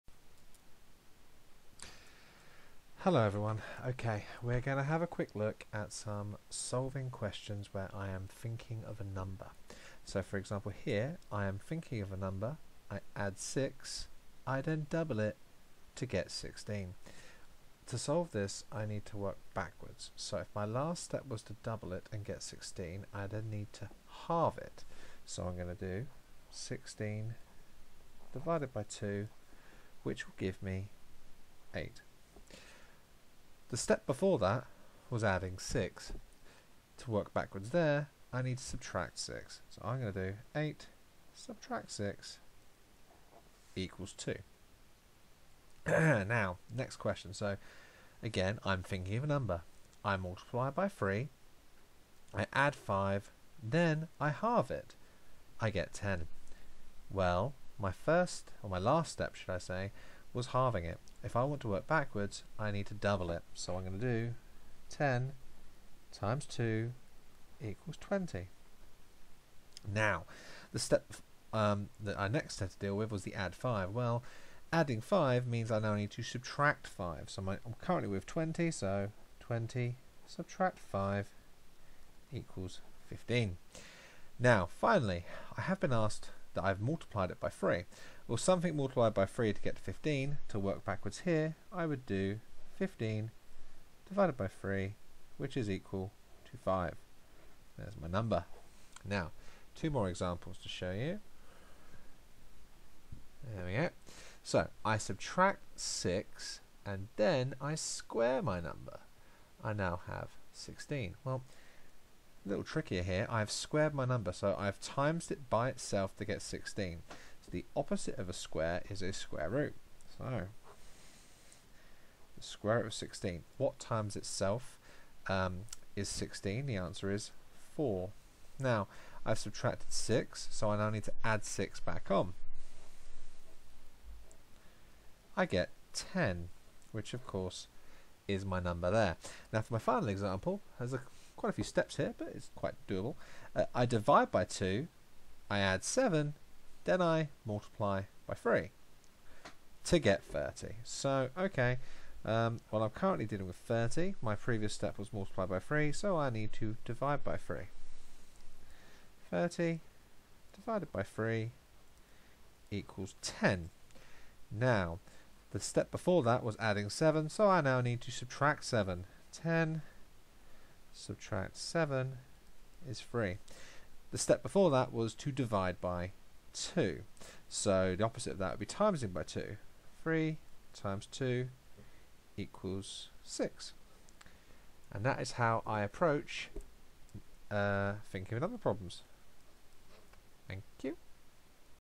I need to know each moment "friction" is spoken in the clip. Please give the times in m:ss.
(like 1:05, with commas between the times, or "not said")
not said.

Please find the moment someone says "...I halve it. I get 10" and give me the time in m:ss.
0:54.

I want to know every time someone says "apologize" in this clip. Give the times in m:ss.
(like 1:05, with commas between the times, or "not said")
not said.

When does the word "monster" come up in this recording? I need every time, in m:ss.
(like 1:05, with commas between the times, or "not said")
not said.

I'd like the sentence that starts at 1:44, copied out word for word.
So, I subtract 6, and then I square my number.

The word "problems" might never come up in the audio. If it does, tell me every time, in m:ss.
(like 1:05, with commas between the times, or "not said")
3:08.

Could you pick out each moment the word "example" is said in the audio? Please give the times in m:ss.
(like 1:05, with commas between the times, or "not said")
0:10, 1:40, 2:20.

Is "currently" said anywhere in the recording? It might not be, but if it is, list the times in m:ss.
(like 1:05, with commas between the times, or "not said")
1:17, 2:32.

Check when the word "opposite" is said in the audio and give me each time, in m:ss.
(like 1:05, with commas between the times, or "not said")
1:57, 2:58.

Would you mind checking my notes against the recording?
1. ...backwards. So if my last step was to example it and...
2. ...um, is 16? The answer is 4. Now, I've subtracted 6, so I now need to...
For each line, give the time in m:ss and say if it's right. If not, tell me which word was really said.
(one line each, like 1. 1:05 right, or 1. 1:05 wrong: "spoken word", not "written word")
1. 0:19 wrong: "double", not "example"
2. 2:05 right.